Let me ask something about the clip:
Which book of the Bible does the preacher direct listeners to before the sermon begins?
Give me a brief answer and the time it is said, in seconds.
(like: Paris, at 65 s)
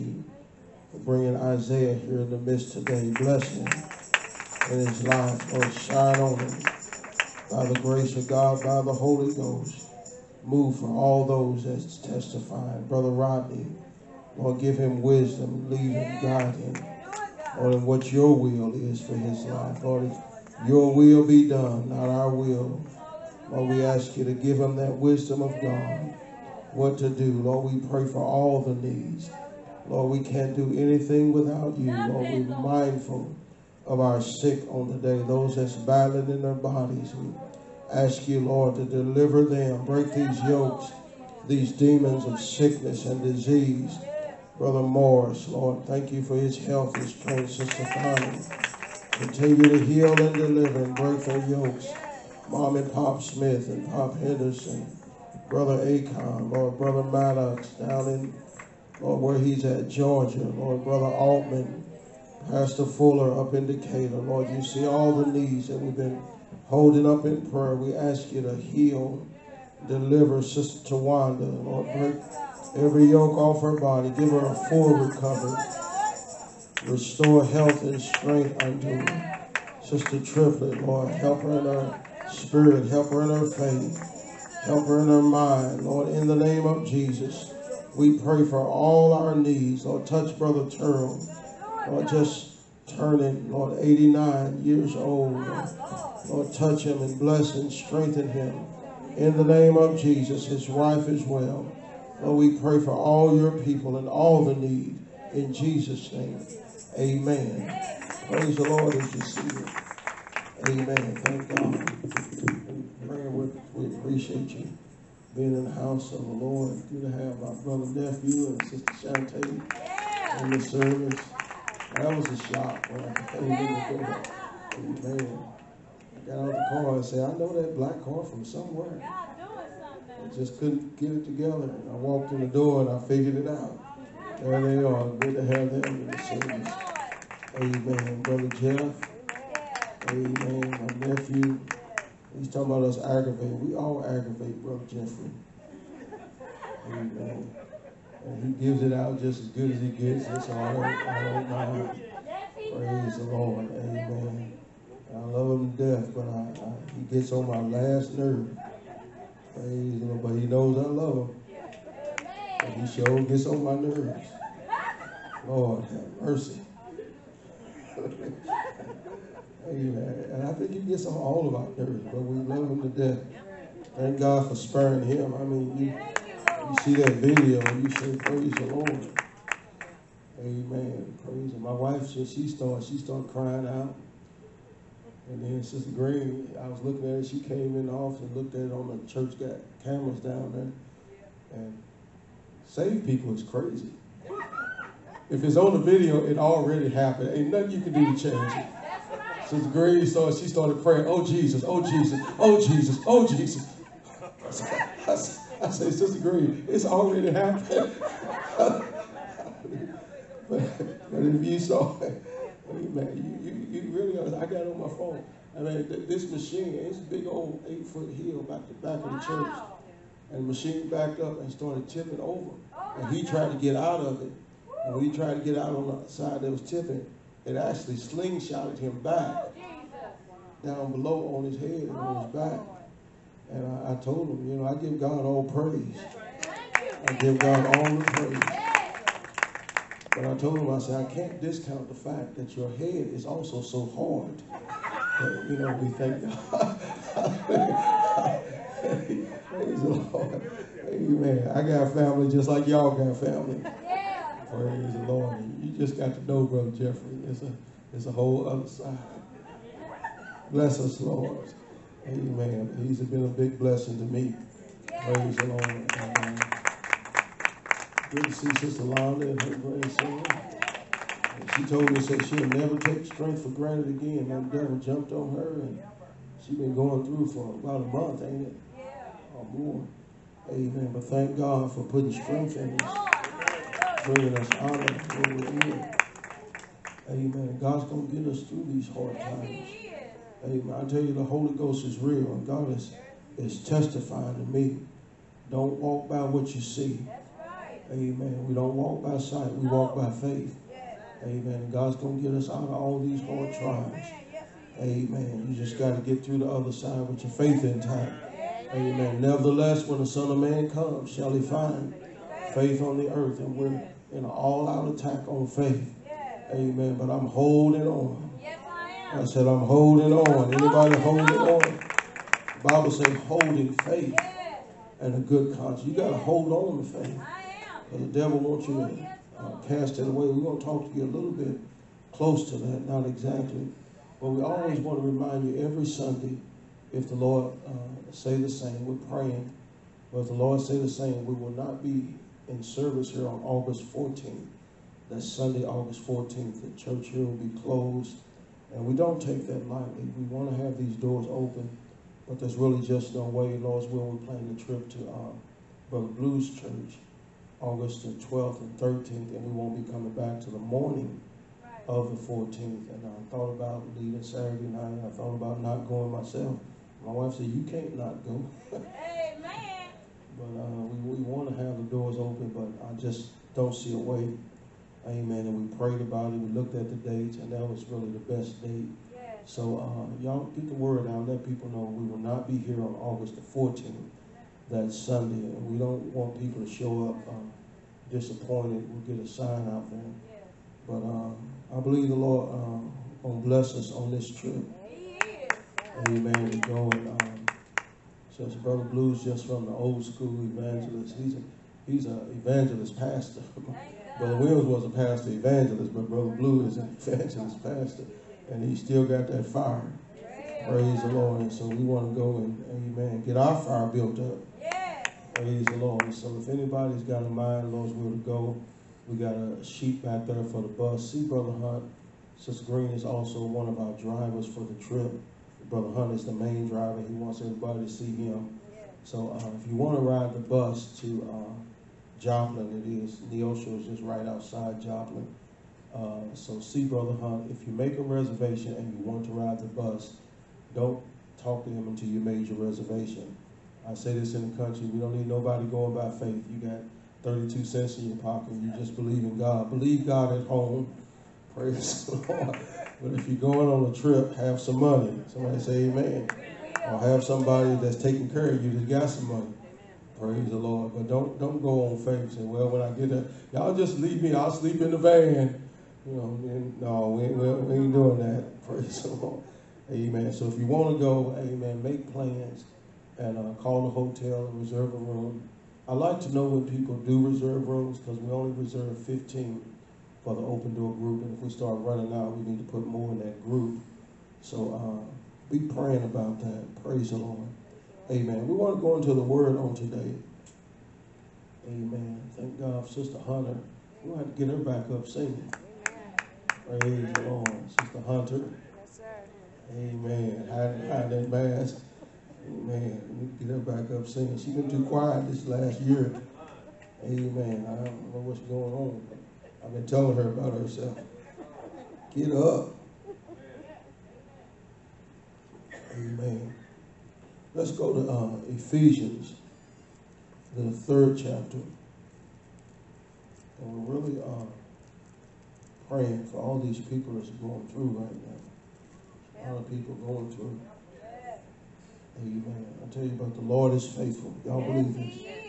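Ephesians, at 518 s.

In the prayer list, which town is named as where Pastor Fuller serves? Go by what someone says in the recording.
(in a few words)
Decatur.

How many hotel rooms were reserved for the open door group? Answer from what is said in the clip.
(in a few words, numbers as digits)
15.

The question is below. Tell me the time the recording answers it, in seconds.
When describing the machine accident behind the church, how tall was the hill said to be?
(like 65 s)
217 s.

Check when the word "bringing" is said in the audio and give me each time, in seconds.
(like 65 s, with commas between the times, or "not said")
0 s, 284 s.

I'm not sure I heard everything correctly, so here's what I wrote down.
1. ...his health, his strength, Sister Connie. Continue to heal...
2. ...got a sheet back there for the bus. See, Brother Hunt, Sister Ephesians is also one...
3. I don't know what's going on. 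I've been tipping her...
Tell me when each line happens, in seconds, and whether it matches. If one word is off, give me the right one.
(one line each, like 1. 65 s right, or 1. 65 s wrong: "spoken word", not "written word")
1. 46 s right
2. 419 s wrong: "Green", not "Ephesians"
3. 507 s wrong: "telling", not "tipping".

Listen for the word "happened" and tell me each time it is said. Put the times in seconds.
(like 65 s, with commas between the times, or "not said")
196 s, 207 s.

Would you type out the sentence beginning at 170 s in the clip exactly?
And I think it gets all of our nerves, but we love him to death.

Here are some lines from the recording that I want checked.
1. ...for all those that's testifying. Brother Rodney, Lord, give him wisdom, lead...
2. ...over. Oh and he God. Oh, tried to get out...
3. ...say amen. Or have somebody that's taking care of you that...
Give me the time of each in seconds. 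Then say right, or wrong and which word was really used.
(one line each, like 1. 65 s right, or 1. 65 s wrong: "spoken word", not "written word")
1. 10 s right
2. 222 s right
3. 455 s right.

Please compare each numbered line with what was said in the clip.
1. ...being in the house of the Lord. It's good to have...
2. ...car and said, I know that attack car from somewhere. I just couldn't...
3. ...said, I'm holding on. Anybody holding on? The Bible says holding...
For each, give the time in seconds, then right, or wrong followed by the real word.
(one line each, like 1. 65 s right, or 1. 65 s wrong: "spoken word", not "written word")
1. 115 s right
2. 126 s wrong: "black", not "attack"
3. 319 s right.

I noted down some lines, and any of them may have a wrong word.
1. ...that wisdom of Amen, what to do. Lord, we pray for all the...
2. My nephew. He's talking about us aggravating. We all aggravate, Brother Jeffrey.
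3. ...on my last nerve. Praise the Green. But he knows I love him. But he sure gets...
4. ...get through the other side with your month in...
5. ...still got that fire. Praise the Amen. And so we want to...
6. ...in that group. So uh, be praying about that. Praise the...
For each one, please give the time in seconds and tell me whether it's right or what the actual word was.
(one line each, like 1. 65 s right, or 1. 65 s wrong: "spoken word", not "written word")
1. 24 s wrong: "God", not "Amen"
2. 140 s right
3. 157 s wrong: "Lord", not "Green"
4. 306 s wrong: "faith", not "month"
5. 408 s wrong: "Lord", not "Amen"
6. 483 s right.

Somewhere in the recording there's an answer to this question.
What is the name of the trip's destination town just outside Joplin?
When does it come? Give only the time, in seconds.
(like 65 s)
433 s.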